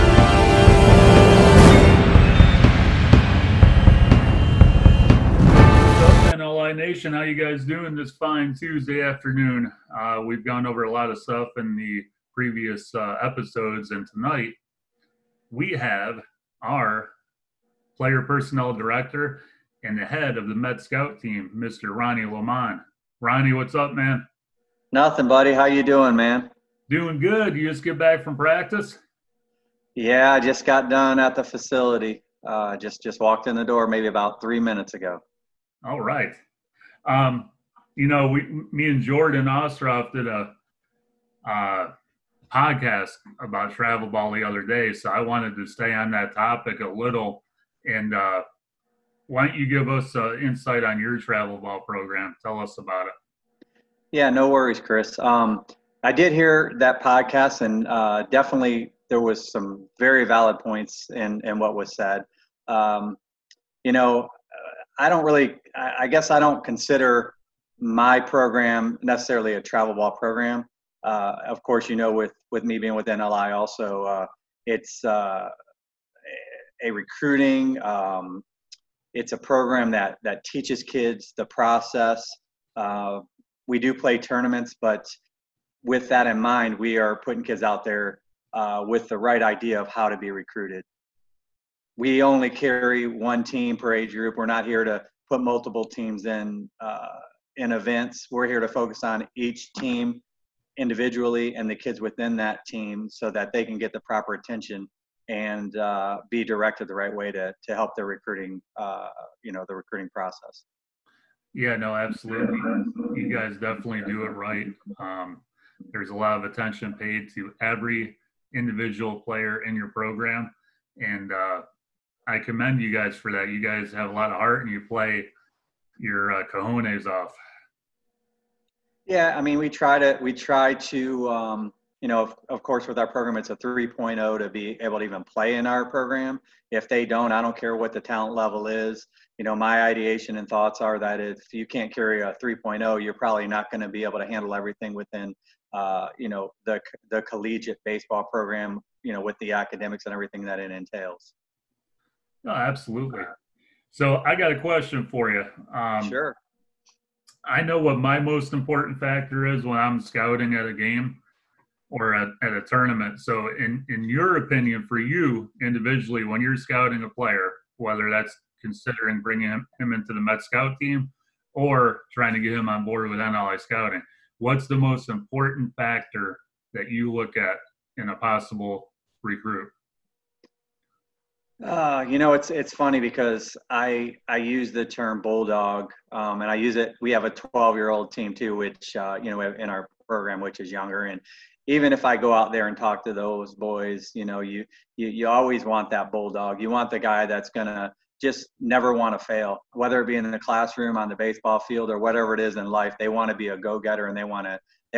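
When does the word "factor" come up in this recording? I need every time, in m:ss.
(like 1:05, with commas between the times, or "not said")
2:38, 2:55.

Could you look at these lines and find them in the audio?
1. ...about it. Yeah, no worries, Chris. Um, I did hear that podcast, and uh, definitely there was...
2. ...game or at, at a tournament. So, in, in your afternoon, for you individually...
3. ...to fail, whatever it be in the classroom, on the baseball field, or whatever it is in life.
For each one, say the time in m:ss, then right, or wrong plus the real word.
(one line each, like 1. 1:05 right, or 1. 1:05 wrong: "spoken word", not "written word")
1. 0:52 right
2. 2:40 wrong: "opinion", not "afternoon"
3. 3:19 wrong: "whether", not "whatever".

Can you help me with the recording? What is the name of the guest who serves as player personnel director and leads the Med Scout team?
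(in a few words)
Ronnie Lemond.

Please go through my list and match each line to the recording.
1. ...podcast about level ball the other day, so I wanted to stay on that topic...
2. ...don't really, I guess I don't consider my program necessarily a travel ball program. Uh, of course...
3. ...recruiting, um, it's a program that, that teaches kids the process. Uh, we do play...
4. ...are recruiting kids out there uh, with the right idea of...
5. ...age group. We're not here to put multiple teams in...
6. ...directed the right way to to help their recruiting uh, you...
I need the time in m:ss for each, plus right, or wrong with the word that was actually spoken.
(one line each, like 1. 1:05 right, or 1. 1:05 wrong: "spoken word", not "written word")
1. 0:42 wrong: "travel", not "level"
2. 1:05 right
3. 1:16 right
4. 1:26 wrong: "putting", not "recruiting"
5. 1:33 right
6. 1:46 right.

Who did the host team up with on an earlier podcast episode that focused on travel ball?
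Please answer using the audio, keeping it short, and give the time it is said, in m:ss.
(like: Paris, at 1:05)
Jordan Ostroff, at 0:39.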